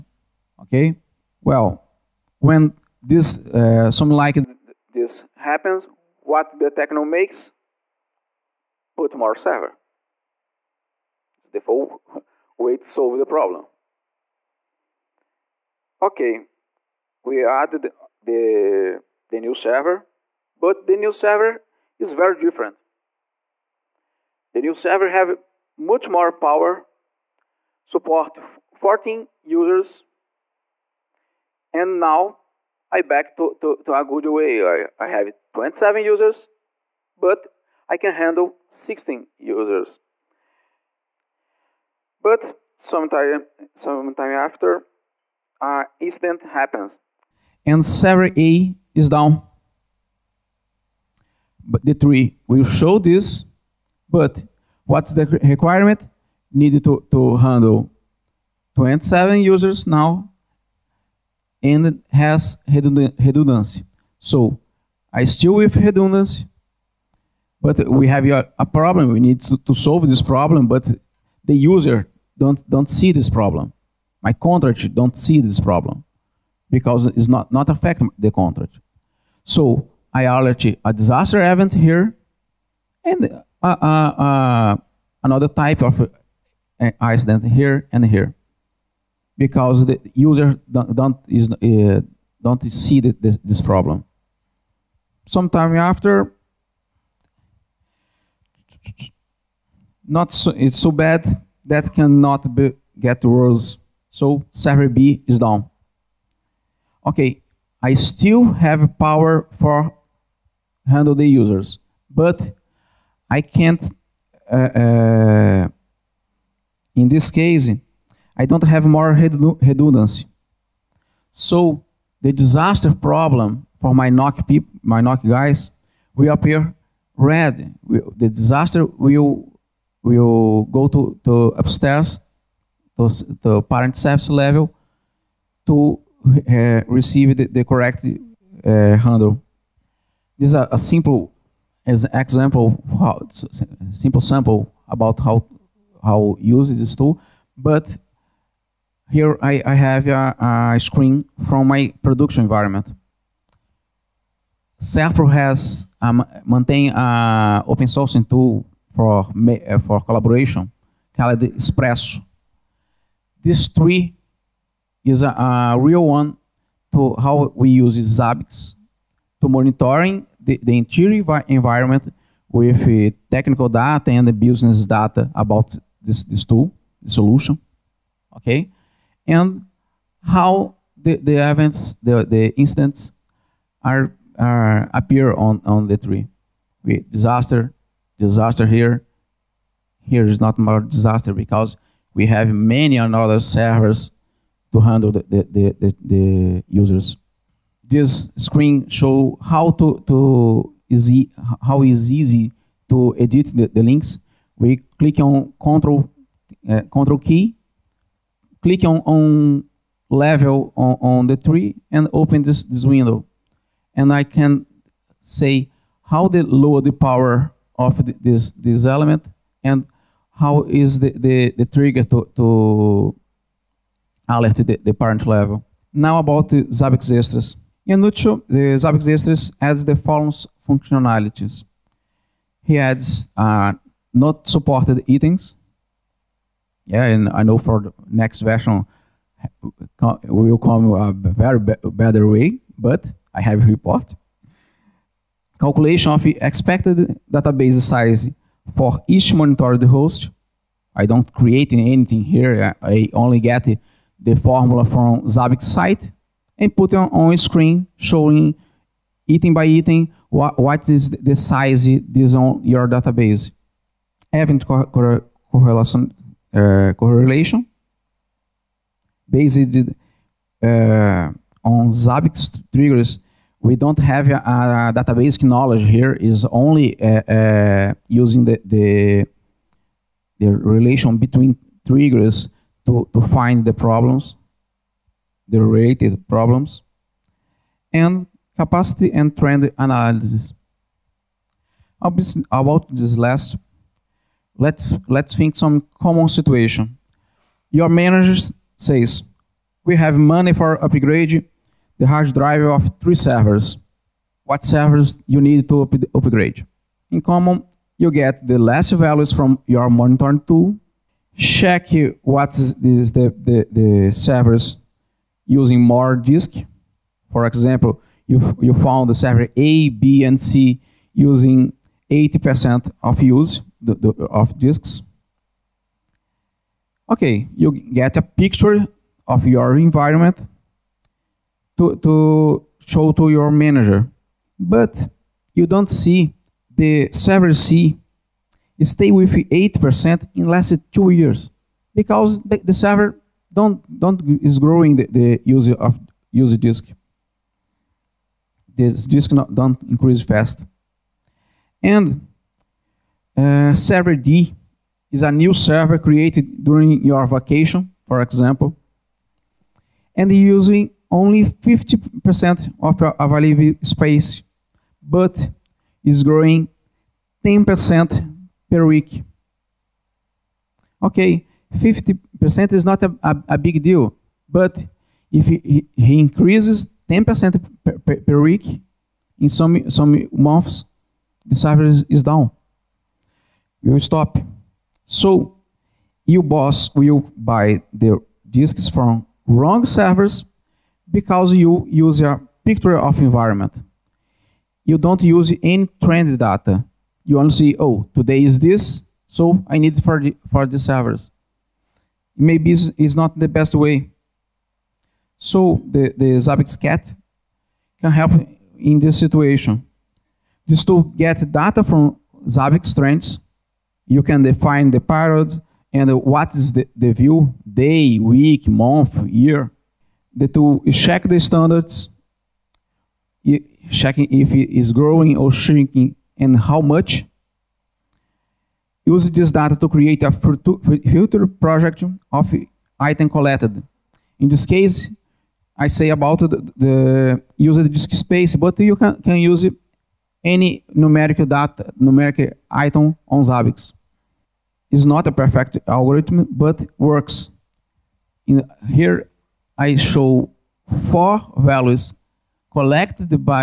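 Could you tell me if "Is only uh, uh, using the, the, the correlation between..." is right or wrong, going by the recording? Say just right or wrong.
wrong.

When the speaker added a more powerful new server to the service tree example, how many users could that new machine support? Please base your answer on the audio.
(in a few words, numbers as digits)
14.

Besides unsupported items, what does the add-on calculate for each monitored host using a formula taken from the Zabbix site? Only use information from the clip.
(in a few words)
Expected database size.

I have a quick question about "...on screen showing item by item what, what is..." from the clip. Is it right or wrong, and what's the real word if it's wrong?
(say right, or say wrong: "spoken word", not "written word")
right.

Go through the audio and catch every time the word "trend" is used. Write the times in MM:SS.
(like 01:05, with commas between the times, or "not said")
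04:49, 06:36, 06:52.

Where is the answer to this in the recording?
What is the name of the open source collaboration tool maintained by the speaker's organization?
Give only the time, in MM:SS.
02:41.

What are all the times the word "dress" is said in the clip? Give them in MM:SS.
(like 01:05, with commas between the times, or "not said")
not said.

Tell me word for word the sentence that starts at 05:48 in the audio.
This disk not, don't increase fast.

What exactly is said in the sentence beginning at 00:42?
But sometime, sometime after, uh, incident happens, and server A is down.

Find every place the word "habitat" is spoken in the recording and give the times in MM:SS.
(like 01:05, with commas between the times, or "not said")
not said.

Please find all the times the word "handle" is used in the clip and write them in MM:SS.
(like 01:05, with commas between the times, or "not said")
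00:38, 00:57, 01:50, 02:19, 03:14.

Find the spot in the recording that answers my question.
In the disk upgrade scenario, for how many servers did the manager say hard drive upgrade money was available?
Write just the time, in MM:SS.
05:02.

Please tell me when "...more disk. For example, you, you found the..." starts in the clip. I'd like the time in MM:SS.
05:15.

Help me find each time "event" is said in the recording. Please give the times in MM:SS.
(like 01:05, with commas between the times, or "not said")
01:21, 03:01, 04:24.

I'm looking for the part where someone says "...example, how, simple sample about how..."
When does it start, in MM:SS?
02:22.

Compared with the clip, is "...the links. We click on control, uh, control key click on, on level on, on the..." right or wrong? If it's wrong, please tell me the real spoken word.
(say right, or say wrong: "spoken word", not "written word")
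right.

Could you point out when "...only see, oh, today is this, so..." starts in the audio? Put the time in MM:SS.
06:37.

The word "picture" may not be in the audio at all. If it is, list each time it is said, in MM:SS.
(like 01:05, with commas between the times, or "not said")
05:28, 06:32.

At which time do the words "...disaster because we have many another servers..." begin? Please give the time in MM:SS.
03:10.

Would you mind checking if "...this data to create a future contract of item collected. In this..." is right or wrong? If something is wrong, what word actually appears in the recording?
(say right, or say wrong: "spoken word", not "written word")
wrong: "project", not "contract".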